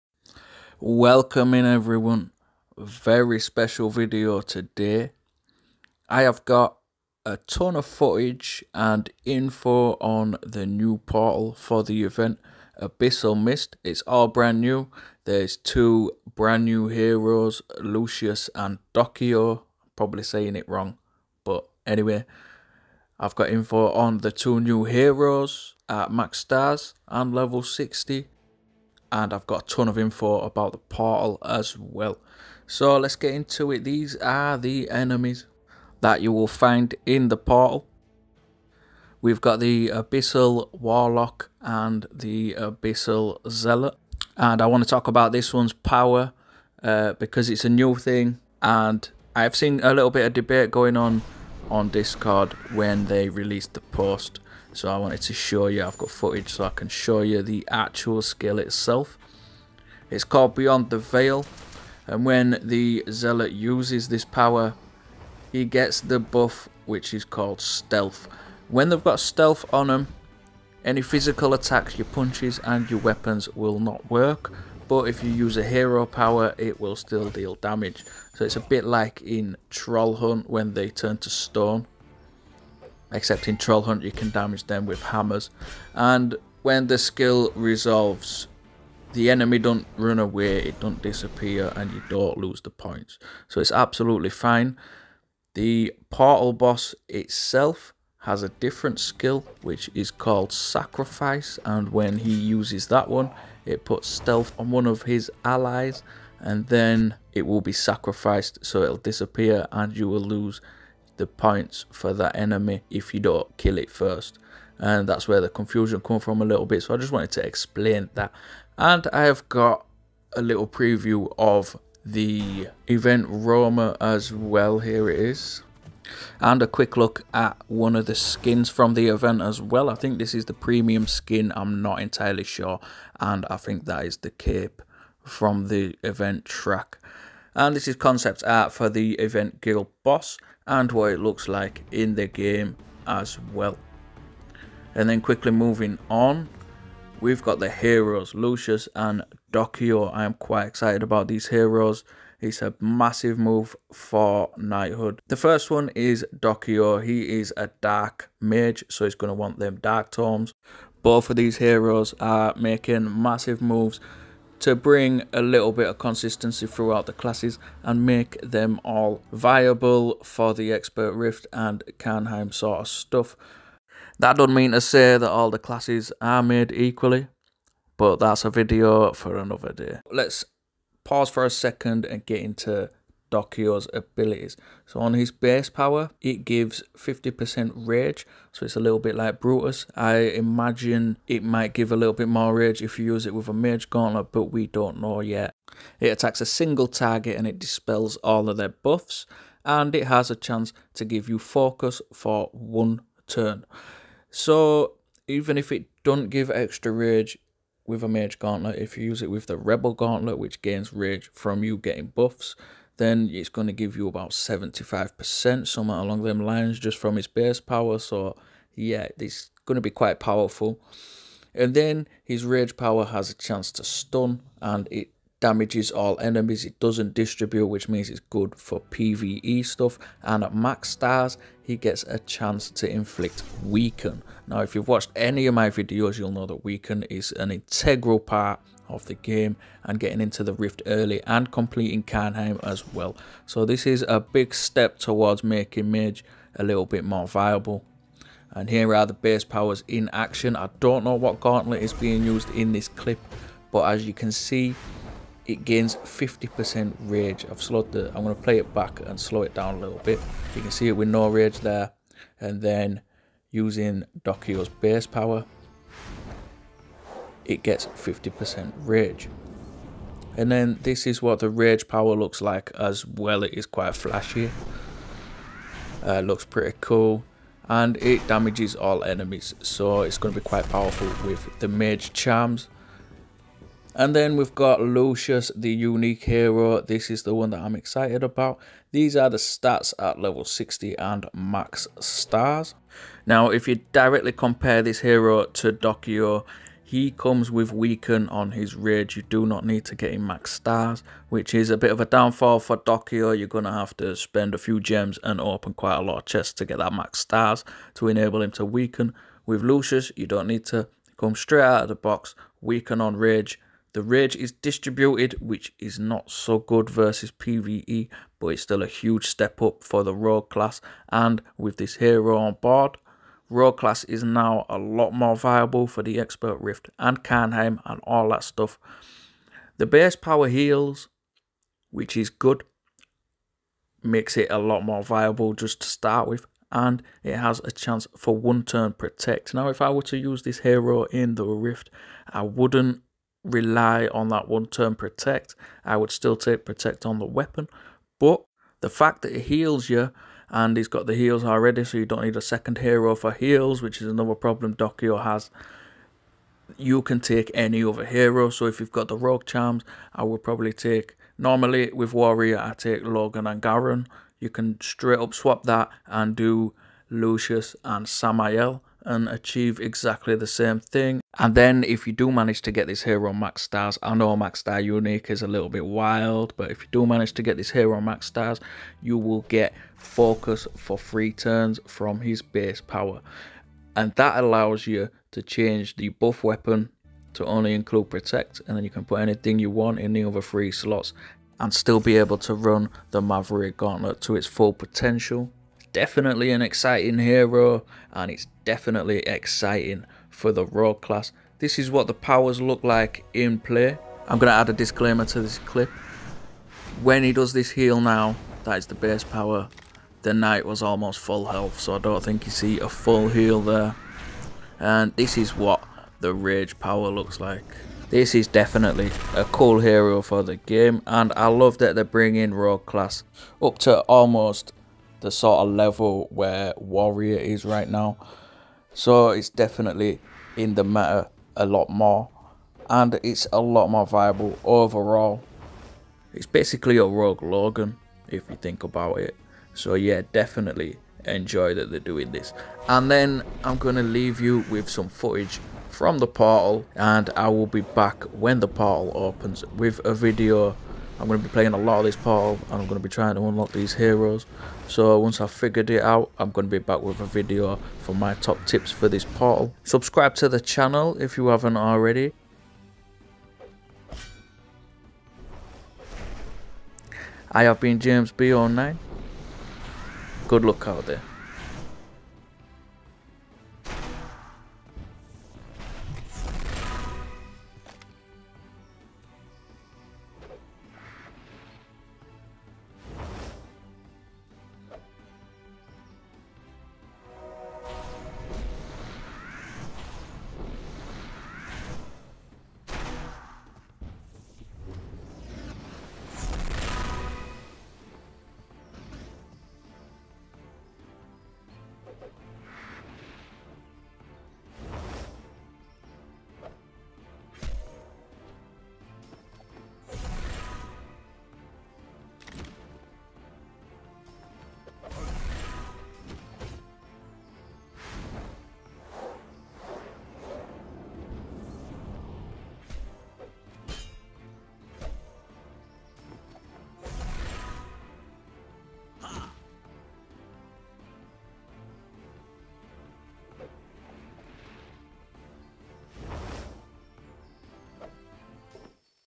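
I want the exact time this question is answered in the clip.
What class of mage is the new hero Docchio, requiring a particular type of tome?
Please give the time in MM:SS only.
02:37.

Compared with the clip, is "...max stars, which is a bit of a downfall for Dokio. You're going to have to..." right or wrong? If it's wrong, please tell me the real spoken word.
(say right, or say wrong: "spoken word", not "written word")
right.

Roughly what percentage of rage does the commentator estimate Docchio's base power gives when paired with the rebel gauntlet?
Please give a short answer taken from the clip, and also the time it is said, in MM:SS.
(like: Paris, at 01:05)
75%, at 03:34.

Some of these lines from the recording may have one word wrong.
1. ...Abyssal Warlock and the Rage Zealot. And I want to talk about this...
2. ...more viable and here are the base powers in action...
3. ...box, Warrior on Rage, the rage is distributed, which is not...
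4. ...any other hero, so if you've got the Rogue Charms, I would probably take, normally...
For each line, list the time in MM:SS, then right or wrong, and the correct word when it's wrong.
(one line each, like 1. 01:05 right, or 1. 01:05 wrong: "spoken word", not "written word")
1. 00:39 wrong: "Abyssal", not "Rage"
2. 04:07 right
3. 05:11 wrong: "Weaken", not "Warrior"
4. 05:57 right.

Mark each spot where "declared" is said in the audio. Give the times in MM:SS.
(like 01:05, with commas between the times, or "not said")
not said.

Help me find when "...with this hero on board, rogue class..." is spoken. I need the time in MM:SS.
05:21.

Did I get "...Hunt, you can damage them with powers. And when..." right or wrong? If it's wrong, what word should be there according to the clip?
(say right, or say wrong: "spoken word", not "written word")
wrong: "hammers", not "powers".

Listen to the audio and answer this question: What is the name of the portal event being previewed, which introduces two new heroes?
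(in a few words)
Abyssal Mist.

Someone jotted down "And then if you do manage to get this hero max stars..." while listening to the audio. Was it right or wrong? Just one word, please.
right.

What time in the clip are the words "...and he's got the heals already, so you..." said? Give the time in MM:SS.
05:50.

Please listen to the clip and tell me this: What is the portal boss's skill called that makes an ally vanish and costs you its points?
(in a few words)
Sacrifice.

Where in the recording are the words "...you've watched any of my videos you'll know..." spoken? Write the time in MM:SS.
03:54.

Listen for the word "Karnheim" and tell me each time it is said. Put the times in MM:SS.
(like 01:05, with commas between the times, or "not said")
02:51, 04:02, 05:27.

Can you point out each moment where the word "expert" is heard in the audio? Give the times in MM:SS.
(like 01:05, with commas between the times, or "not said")
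02:50, 05:26.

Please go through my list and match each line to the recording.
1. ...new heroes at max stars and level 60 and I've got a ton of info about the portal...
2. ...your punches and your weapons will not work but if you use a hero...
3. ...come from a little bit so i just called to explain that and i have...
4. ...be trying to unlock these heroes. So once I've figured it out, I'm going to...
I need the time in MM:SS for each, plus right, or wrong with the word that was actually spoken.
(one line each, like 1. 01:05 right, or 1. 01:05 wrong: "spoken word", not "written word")
1. 00:24 right
2. 01:11 right
3. 01:56 wrong: "wanted", not "called"
4. 07:32 right.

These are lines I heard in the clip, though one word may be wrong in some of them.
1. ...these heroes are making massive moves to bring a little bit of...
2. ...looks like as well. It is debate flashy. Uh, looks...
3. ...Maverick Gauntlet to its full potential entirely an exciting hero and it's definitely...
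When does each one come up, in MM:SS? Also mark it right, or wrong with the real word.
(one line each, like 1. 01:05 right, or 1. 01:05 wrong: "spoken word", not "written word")
1. 02:41 right
2. 04:32 wrong: "quite", not "debate"
3. 06:33 wrong: "definitely", not "entirely".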